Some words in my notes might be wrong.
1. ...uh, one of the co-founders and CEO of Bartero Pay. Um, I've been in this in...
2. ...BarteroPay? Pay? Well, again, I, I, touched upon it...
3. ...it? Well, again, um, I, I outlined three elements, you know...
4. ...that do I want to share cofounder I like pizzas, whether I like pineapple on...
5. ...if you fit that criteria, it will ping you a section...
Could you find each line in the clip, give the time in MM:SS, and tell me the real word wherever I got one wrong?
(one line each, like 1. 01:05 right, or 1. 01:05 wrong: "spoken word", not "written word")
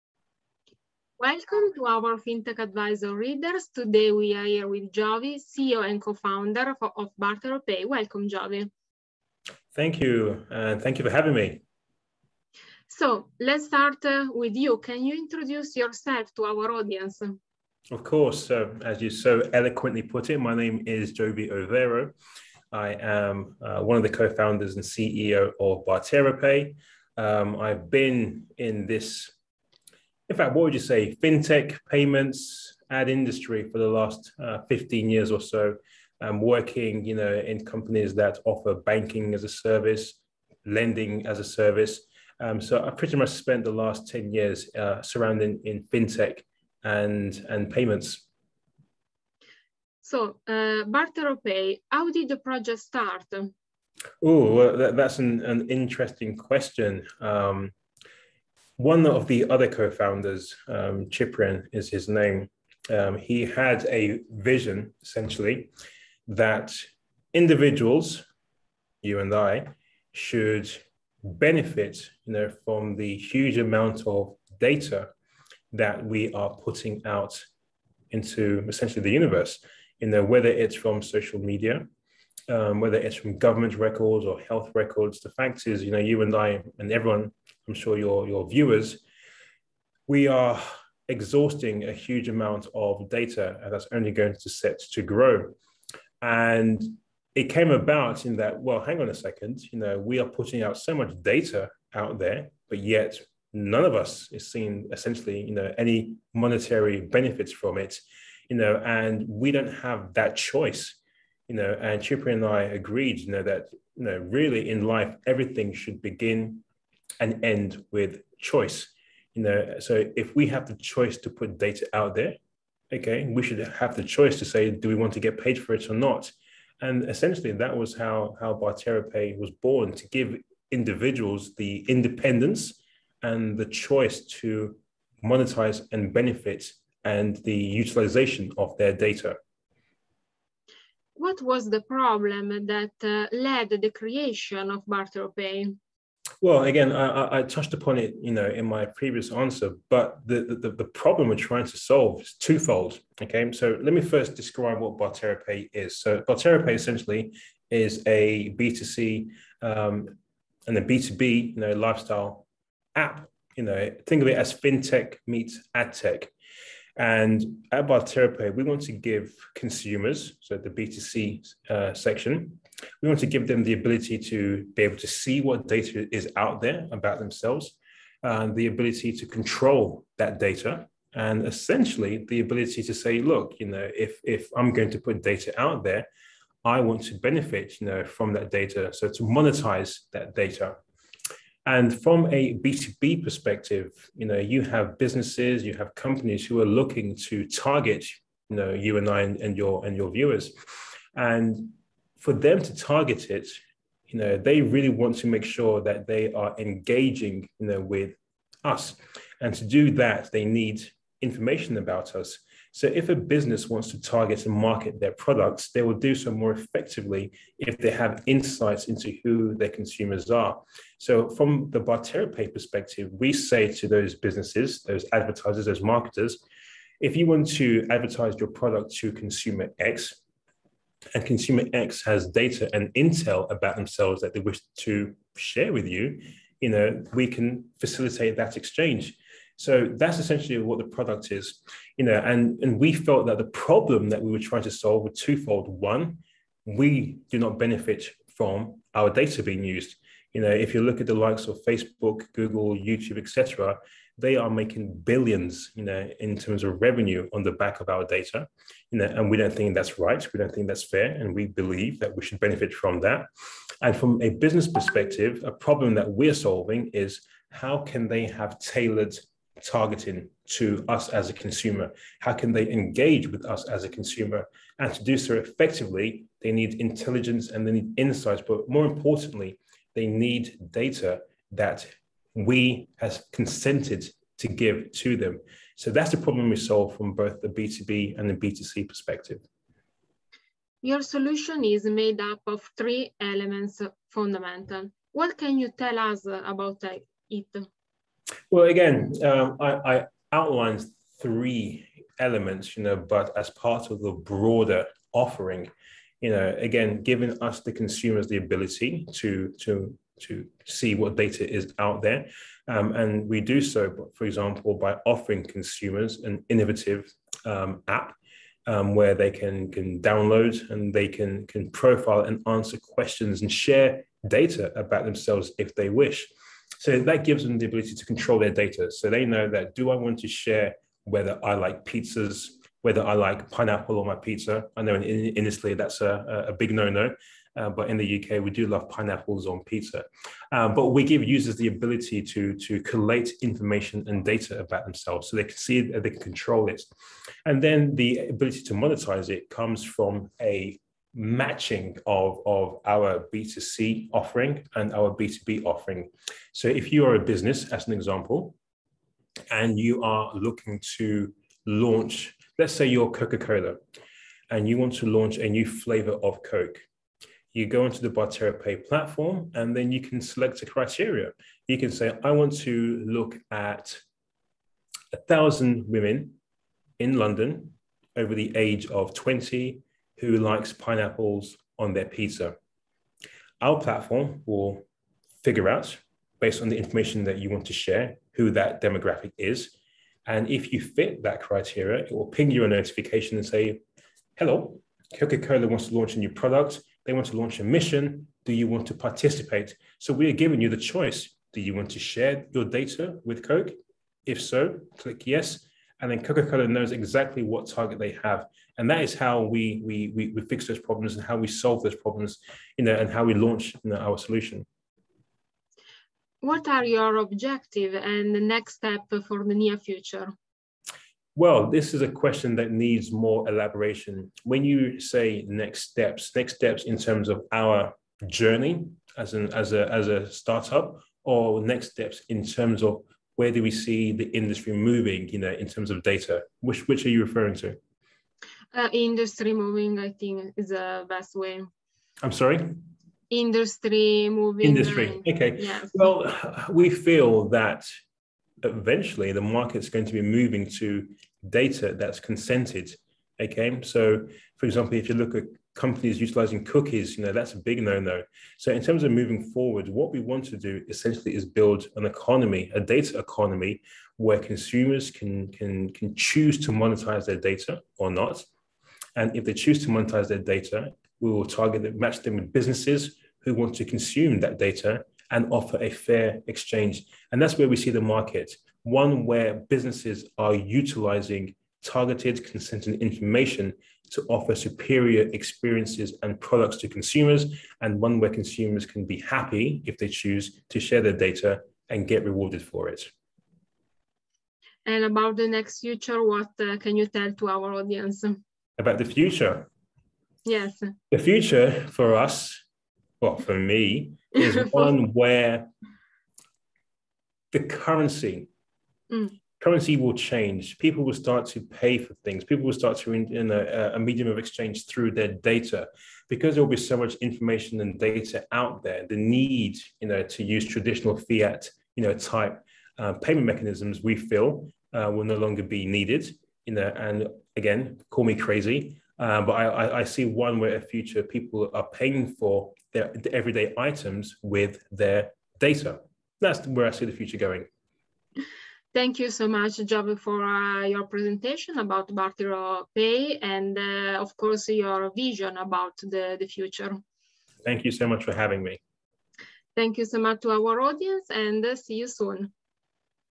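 1. 00:23 right
2. 02:24 right
3. 04:56 right
4. 05:29 wrong: "whether", not "cofounder"
5. 06:30 wrong: "notification", not "section".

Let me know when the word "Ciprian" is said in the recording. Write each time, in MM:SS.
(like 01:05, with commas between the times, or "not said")
01:01, 01:52.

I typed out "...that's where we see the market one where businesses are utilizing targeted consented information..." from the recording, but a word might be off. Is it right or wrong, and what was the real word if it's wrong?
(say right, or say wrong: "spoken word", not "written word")
right.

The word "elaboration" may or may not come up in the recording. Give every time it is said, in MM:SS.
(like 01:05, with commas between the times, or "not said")
07:03.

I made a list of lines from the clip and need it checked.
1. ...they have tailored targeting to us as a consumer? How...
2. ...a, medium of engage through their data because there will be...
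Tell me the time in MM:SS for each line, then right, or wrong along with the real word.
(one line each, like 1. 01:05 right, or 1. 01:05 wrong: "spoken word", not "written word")
1. 04:28 right
2. 08:33 wrong: "exchange", not "engage".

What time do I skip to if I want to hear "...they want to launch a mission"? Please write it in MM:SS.
06:37.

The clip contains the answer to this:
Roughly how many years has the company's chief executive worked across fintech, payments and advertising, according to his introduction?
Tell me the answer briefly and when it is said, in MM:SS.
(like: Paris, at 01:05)
15, at 00:34.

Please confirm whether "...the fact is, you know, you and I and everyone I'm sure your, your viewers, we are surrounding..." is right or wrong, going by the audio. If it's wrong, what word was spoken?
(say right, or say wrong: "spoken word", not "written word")
wrong: "exhausting", not "surrounding".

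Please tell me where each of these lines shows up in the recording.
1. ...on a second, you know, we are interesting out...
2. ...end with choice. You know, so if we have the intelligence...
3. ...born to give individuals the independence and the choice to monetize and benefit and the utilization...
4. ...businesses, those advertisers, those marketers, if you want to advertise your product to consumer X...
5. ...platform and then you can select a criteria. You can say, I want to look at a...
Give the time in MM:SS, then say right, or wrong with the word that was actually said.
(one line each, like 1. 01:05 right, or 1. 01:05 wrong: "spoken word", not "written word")
1. 01:38 wrong: "putting", not "interesting"
2. 01:57 wrong: "choice", not "intelligence"
3. 02:09 right
4. 03:44 right
5. 06:08 right.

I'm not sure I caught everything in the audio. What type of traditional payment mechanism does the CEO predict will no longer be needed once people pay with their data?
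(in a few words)
fiat.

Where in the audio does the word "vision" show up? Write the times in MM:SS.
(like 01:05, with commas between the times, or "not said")
01:04, 09:05.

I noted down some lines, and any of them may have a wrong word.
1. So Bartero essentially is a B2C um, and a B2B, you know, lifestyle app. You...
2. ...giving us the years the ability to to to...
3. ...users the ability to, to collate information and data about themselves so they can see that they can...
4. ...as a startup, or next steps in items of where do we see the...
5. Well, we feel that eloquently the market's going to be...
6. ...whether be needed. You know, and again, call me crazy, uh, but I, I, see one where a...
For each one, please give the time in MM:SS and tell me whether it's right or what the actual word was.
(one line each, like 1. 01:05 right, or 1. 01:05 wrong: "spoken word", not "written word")
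1. 02:35 right
2. 05:07 wrong: "consumers", not "years"
3. 05:41 right
4. 07:09 wrong: "terms", not "items"
5. 07:25 wrong: "eventually", not "eloquently"
6. 08:45 wrong: "longer", not "whether".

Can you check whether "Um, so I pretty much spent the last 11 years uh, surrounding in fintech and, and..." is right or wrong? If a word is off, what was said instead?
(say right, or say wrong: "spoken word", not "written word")
wrong: "10", not "11".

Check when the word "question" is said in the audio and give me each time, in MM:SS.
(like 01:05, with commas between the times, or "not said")
00:56, 05:22, 07:02.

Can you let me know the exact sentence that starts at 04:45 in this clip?
So that's the problem we solve from both the B2B and the B2C perspective.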